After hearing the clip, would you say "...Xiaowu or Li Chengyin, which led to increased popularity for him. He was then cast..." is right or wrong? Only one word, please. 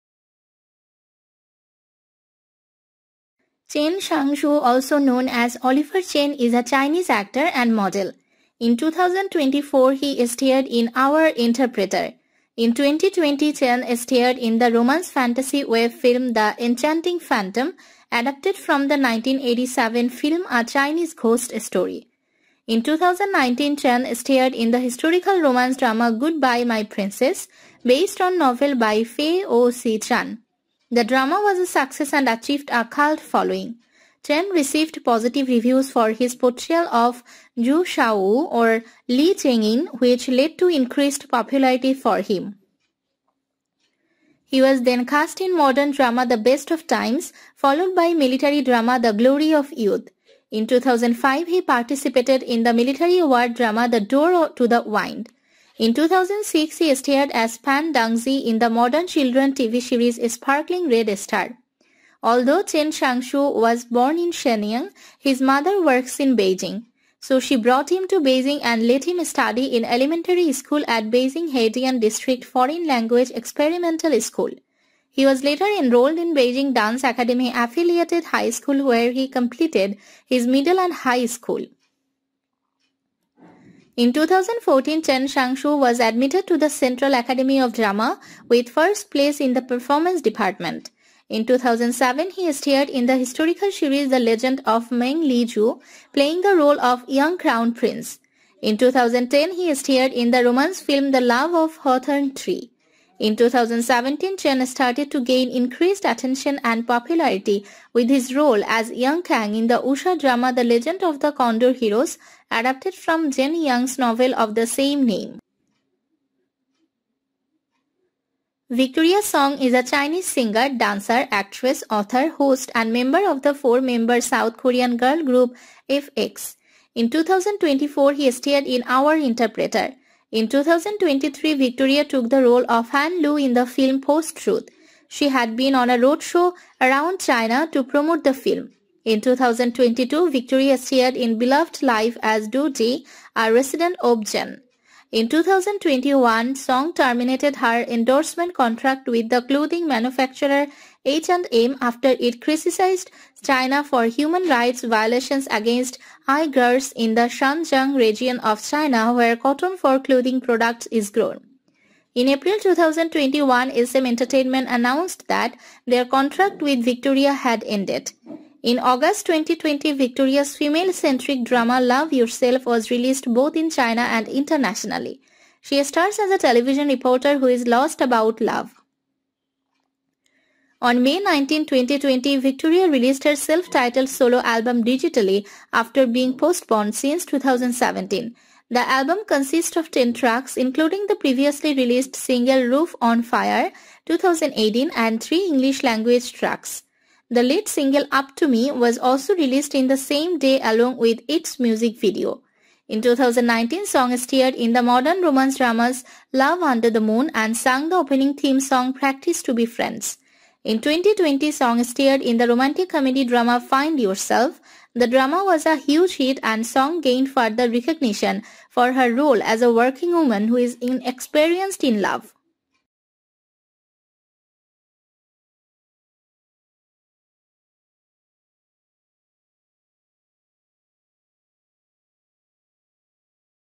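right.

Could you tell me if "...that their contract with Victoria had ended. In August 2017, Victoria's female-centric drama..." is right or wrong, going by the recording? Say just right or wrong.
wrong.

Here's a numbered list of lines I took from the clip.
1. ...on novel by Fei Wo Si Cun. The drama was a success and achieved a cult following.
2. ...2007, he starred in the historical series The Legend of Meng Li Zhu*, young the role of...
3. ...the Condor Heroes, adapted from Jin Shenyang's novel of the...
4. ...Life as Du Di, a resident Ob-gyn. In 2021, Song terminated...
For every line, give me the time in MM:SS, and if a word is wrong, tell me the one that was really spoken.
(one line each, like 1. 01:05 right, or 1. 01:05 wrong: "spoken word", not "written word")
1. 00:28 right
2. 01:31 wrong: "playing", not "young"
3. 01:51 wrong: "Yong", not "Shenyang"
4. 02:21 right.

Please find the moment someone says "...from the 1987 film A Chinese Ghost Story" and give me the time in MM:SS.
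00:18.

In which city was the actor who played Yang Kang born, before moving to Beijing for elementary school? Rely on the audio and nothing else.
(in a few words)
Shenyang.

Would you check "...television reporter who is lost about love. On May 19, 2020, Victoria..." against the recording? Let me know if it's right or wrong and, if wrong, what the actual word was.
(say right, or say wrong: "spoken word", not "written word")
right.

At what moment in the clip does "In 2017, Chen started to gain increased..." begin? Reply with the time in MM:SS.
01:43.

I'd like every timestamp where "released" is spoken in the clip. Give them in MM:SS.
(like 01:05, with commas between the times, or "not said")
02:52, 03:02, 03:11, 03:19.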